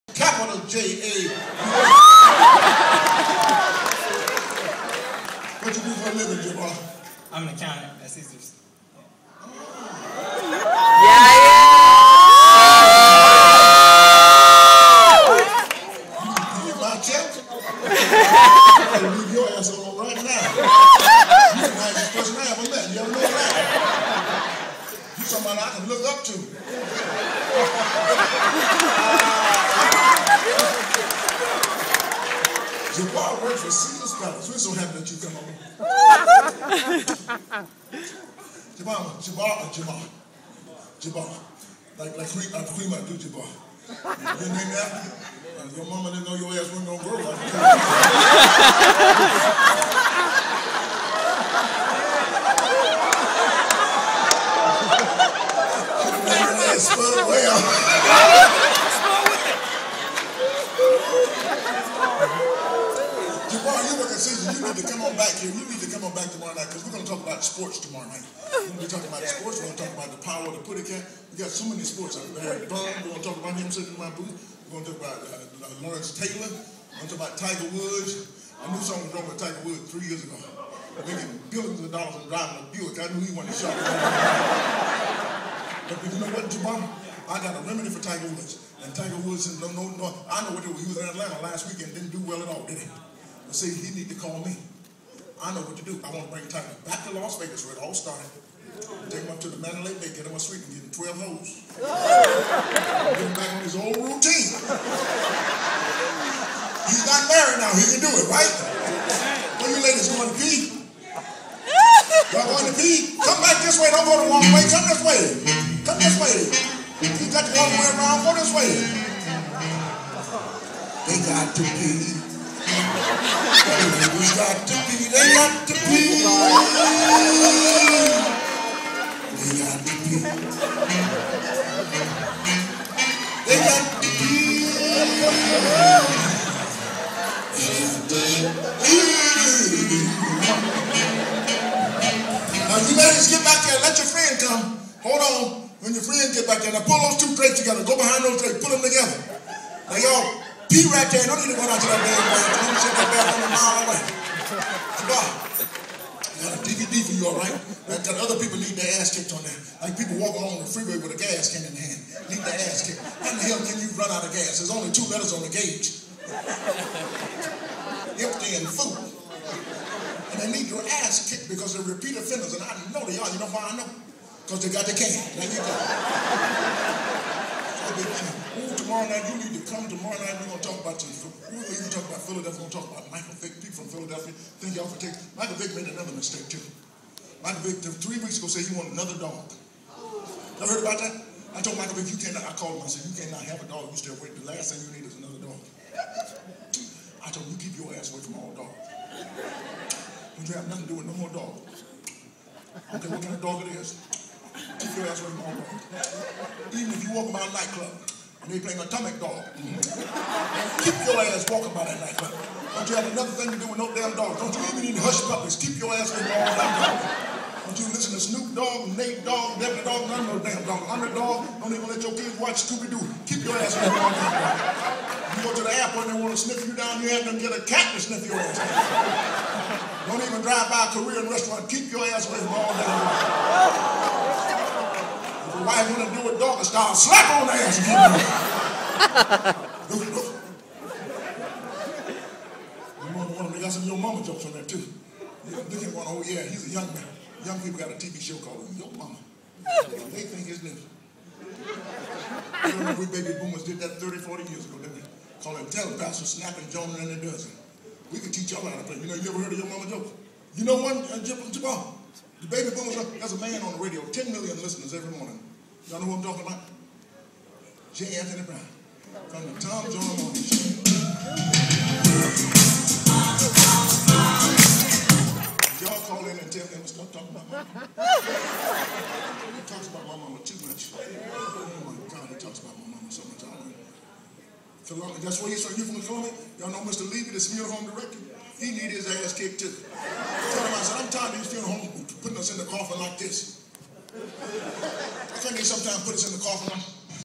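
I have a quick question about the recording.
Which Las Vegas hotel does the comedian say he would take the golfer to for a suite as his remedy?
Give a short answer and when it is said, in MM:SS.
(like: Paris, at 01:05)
Mandalay Bay, at 01:39.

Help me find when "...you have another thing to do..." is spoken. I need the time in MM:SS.
03:32.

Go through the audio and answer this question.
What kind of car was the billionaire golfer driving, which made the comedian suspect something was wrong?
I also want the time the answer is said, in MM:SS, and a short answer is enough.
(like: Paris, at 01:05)
Buick, at 01:22.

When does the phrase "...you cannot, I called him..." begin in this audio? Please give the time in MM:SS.
03:12.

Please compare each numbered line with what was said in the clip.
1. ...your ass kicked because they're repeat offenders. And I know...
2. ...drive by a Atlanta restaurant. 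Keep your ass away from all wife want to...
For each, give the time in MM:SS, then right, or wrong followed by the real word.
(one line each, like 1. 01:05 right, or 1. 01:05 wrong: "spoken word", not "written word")
1. 02:50 right
2. 03:50 wrong: "Korean", not "Atlanta".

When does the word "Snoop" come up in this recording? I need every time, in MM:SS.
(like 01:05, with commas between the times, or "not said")
03:38.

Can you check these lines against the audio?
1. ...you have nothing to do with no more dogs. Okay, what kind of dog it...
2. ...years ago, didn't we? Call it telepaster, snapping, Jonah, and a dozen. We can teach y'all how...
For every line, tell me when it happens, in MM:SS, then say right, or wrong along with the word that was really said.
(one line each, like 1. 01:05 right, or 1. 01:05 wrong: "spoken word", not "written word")
1. 03:20 right
2. 04:14 right.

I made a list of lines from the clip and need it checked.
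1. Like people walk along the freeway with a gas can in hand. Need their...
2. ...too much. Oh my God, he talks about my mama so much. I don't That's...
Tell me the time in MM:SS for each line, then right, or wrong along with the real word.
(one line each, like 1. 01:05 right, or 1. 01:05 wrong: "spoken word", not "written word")
1. 02:39 right
2. 04:40 right.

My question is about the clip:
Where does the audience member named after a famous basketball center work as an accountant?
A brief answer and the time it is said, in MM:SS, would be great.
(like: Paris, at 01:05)
Caesars, at 00:08.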